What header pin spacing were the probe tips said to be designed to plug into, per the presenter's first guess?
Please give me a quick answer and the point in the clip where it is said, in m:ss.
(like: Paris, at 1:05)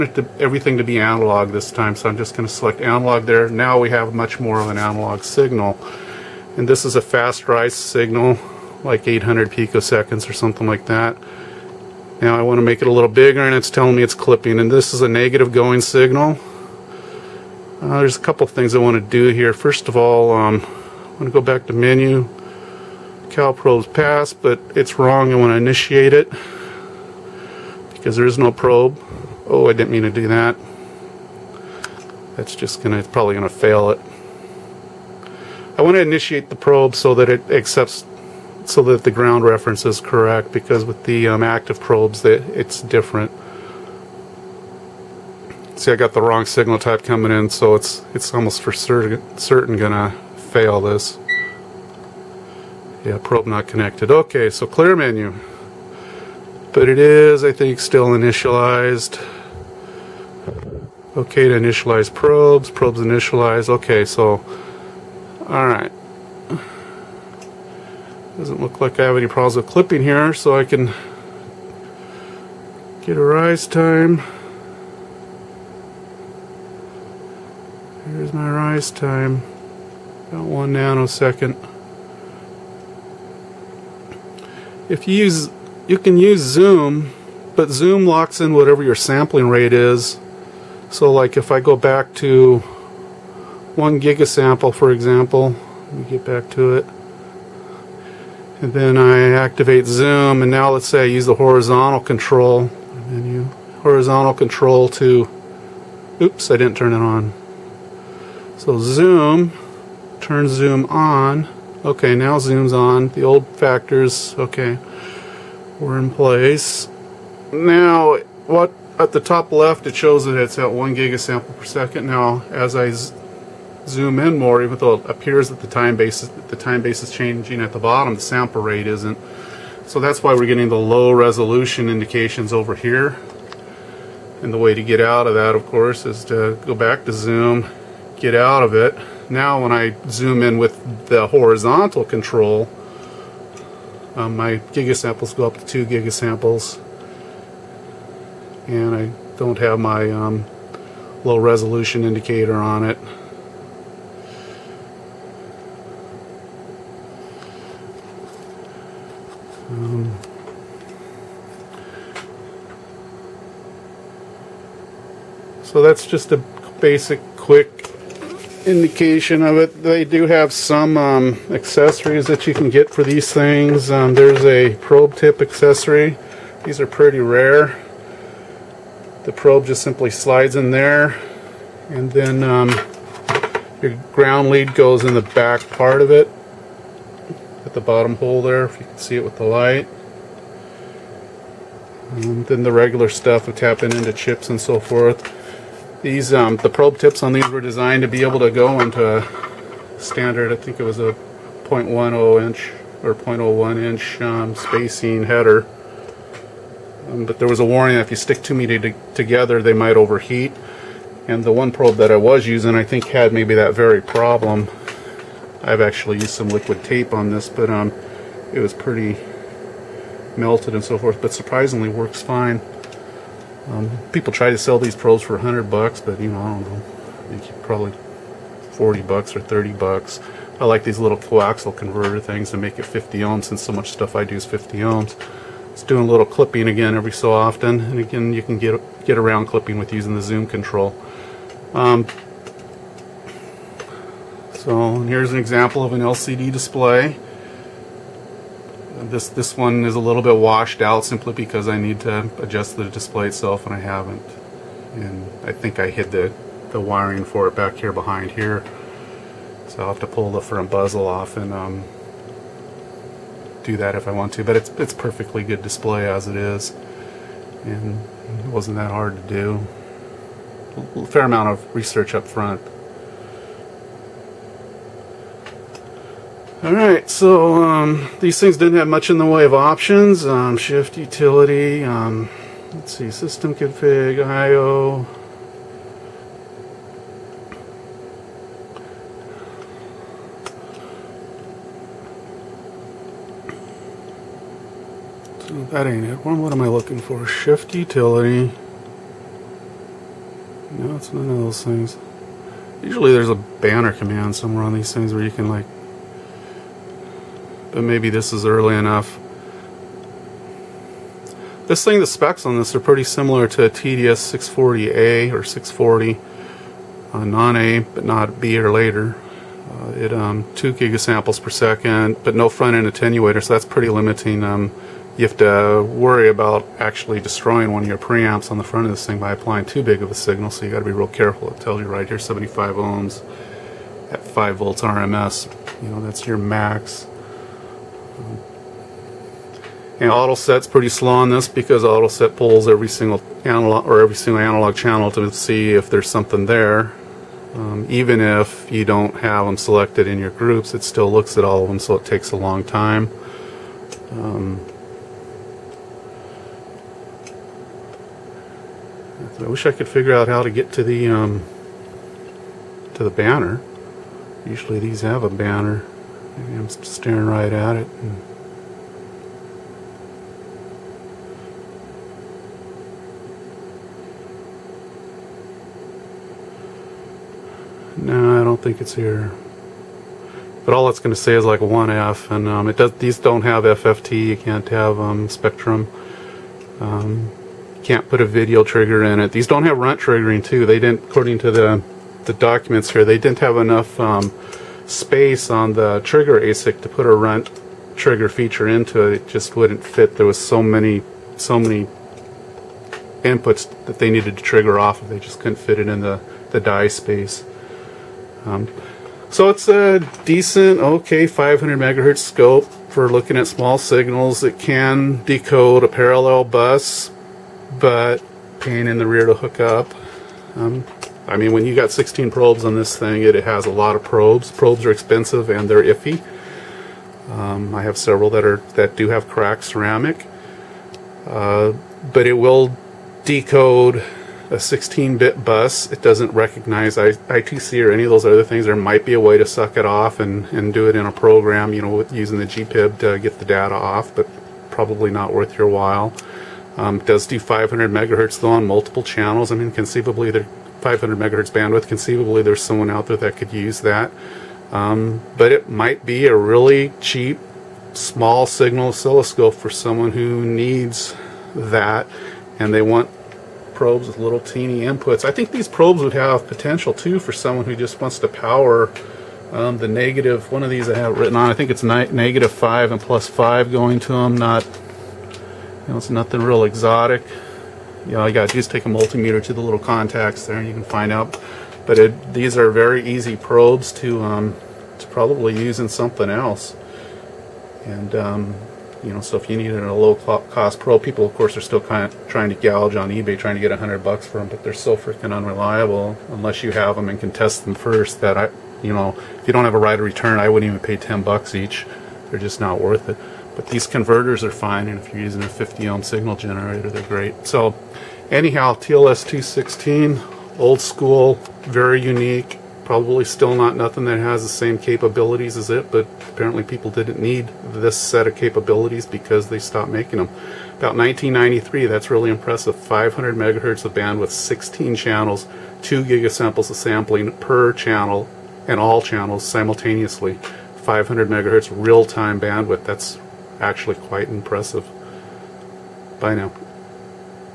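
0.10 inch, at 3:21.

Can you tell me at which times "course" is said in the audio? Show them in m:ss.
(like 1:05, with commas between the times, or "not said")
2:15, 8:11.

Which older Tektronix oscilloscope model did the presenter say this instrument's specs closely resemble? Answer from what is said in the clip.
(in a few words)
TDS 640A.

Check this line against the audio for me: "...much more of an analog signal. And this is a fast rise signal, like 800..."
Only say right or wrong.
right.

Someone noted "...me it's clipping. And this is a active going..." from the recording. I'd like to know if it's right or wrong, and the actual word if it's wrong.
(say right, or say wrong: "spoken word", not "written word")
wrong: "negative", not "active".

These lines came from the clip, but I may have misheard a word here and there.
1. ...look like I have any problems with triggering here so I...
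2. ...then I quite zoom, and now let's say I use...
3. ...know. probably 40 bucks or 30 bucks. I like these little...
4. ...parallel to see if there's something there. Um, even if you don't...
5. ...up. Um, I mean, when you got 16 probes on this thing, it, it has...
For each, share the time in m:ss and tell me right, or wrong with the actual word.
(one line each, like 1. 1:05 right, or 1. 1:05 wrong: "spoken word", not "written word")
1. 1:08 wrong: "clipping", not "triggering"
2. 1:38 wrong: "activate", not "quite"
3. 3:46 right
4. 5:44 wrong: "channel", not "parallel"
5. 6:59 right.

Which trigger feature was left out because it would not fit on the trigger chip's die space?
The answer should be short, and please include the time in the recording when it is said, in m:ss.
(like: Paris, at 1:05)
Runt triggering, at 6:29.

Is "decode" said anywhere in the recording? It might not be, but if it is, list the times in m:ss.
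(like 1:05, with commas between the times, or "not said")
6:55, 7:13.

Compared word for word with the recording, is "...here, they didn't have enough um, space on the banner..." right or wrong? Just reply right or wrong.
wrong.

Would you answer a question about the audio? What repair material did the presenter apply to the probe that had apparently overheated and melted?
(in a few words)
Liquid tape.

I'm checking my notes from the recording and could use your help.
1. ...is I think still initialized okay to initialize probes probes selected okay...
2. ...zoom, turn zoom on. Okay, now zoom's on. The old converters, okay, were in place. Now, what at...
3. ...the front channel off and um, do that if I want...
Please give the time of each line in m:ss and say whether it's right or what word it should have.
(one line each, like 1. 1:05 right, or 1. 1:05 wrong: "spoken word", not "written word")
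1. 0:56 wrong: "initialized", not "selected"
2. 1:48 wrong: "factors", not "converters"
3. 4:20 wrong: "bezel", not "channel".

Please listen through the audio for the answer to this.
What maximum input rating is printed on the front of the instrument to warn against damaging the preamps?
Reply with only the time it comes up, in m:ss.
5:34.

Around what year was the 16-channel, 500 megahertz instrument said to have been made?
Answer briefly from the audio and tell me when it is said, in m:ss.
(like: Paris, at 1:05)
1993, at 8:40.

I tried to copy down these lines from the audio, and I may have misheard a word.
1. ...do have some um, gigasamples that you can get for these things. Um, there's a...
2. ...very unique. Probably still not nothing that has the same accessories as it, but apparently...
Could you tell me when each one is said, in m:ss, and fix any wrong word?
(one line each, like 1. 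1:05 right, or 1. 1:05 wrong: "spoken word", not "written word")
1. 2:50 wrong: "accessories", not "gigasamples"
2. 8:31 wrong: "capabilities", not "accessories".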